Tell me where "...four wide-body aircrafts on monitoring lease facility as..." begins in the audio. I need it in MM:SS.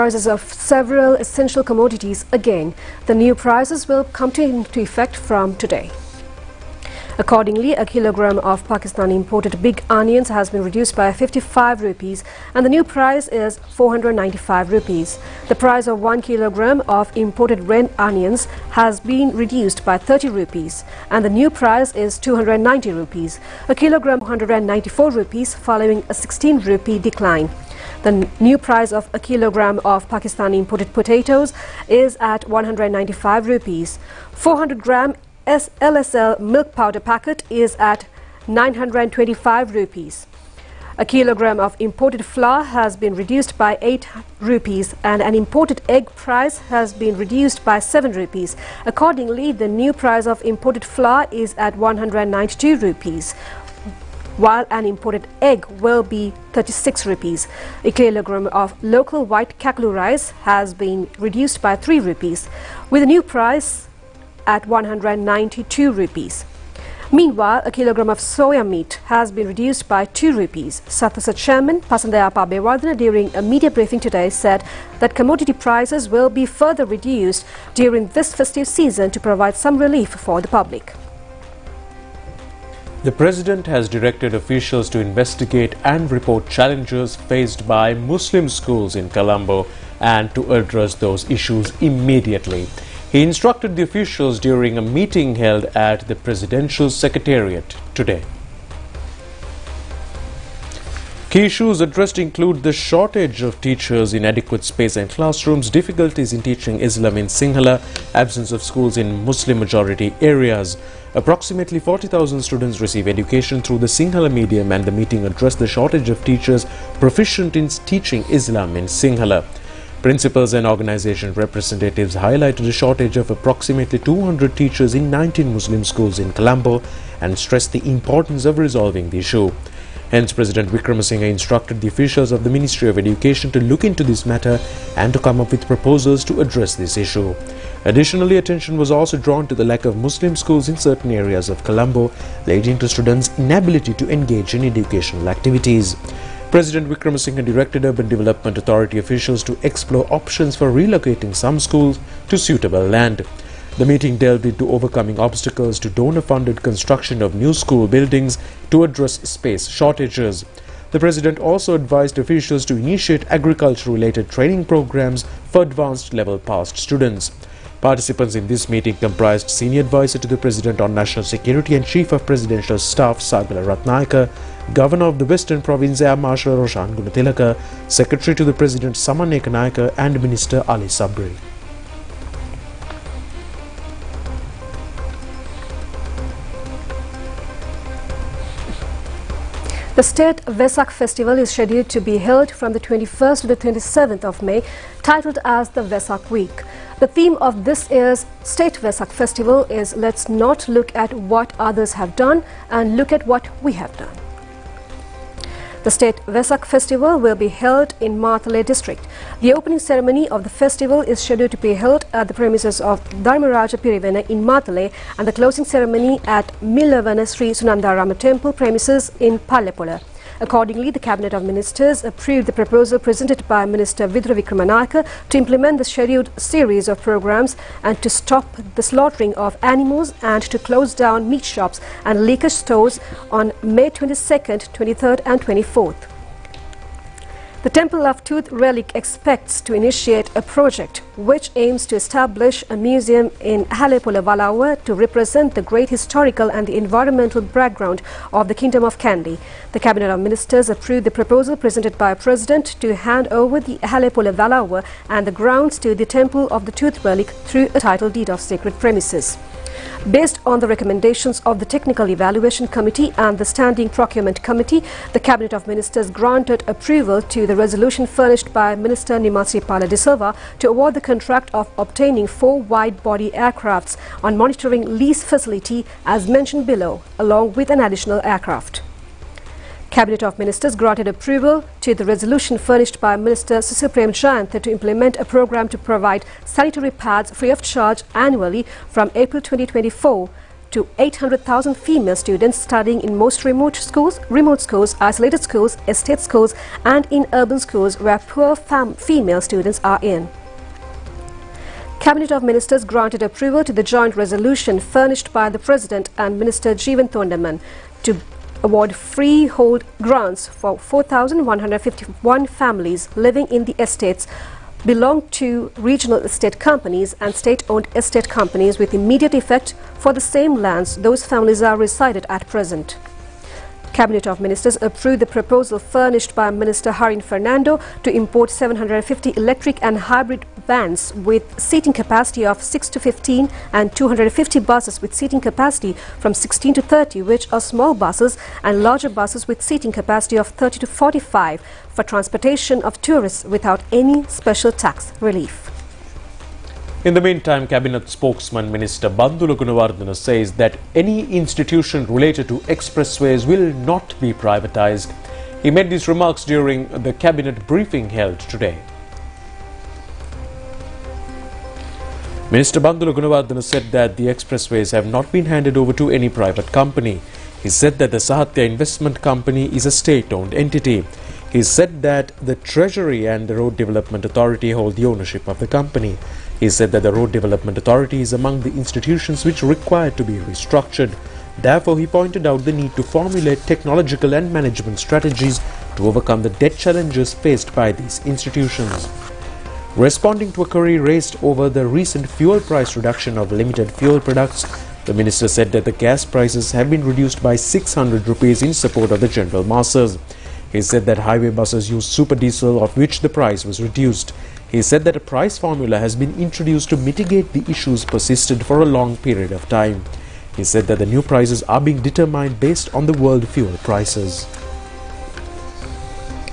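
04:32.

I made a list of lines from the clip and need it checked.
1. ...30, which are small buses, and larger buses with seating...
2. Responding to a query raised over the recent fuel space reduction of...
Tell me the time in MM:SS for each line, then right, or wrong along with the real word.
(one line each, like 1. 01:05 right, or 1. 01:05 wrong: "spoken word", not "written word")
1. 05:36 right
2. 06:29 wrong: "price", not "space".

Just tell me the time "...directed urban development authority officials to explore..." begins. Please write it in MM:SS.
02:27.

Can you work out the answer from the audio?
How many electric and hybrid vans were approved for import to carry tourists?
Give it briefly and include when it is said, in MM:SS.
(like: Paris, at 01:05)
750, at 05:28.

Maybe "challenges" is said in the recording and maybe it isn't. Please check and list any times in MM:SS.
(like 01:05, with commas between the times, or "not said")
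01:26, 06:26.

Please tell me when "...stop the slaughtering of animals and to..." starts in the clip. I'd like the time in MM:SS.
03:48.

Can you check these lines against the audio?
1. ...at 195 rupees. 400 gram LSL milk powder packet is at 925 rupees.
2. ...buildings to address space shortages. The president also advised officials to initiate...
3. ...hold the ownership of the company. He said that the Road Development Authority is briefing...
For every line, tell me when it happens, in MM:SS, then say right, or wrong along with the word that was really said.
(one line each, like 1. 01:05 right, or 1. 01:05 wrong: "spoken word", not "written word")
1. 00:32 right
2. 02:37 right
3. 06:14 wrong: "among", not "briefing".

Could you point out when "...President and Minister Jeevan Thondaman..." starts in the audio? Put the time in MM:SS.
05:05.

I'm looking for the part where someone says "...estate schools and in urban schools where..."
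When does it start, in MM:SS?
04:55.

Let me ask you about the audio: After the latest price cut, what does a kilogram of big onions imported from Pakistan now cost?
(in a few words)
495 rupees.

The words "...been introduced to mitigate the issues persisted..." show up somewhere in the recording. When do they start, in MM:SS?
06:46.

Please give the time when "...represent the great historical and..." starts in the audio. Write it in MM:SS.
04:04.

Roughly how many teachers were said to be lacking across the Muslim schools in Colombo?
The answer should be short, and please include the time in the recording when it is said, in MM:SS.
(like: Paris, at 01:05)
200, at 02:03.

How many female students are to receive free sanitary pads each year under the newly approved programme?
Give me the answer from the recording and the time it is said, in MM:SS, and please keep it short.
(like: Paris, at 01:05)
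800,000, at 04:50.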